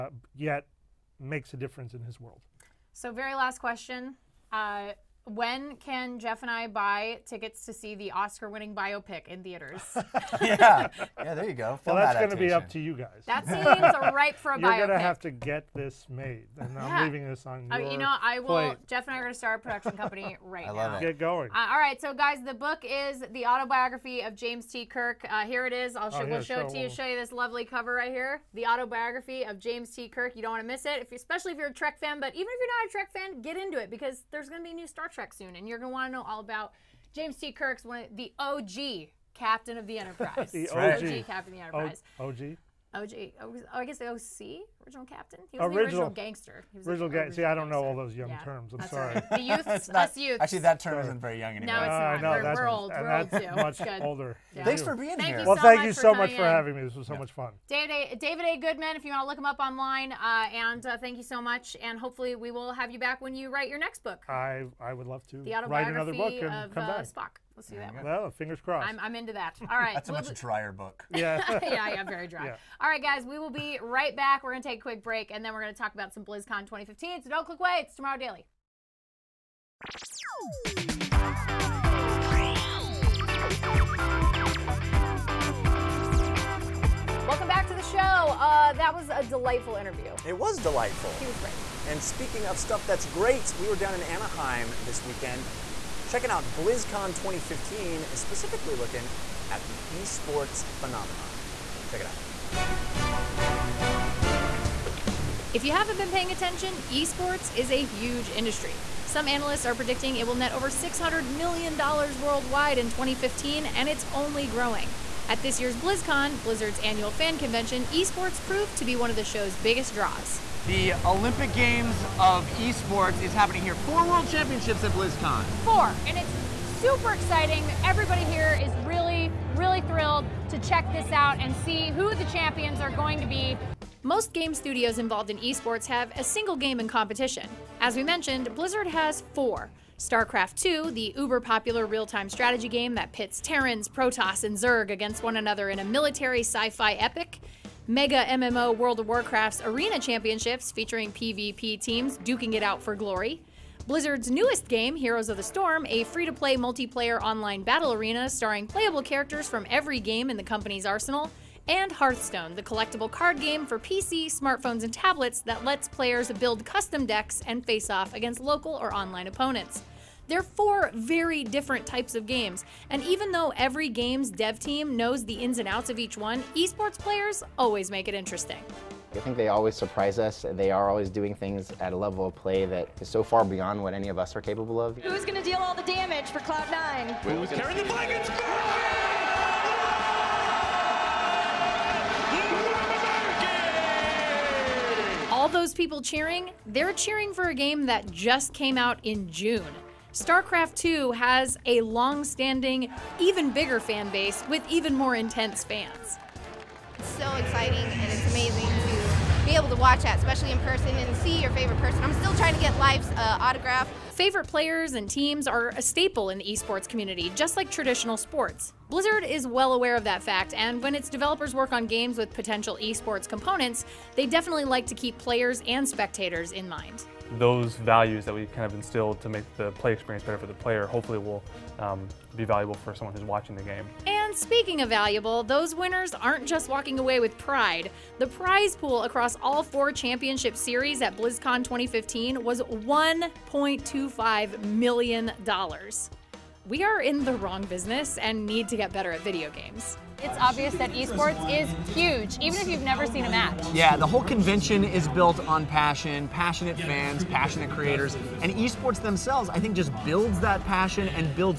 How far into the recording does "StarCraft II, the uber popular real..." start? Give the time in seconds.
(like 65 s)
139 s.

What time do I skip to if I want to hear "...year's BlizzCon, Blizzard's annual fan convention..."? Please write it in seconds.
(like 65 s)
115 s.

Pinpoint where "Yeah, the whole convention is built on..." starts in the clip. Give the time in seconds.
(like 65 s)
253 s.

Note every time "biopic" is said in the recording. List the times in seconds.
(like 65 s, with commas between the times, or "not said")
8 s, 14 s.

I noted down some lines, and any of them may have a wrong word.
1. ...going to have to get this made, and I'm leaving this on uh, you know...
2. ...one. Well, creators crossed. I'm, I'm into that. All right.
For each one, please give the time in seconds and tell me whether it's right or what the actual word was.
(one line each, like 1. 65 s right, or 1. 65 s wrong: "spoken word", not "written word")
1. 14 s right
2. 67 s wrong: "fingers", not "creators".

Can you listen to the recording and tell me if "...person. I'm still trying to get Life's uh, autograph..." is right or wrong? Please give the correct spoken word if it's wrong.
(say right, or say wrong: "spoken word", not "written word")
right.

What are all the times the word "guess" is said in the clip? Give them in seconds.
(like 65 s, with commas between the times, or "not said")
43 s.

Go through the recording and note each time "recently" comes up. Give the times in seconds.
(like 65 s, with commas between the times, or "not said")
not said.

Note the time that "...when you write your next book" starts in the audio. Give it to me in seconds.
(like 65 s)
63 s.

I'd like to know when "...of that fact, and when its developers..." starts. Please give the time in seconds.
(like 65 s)
219 s.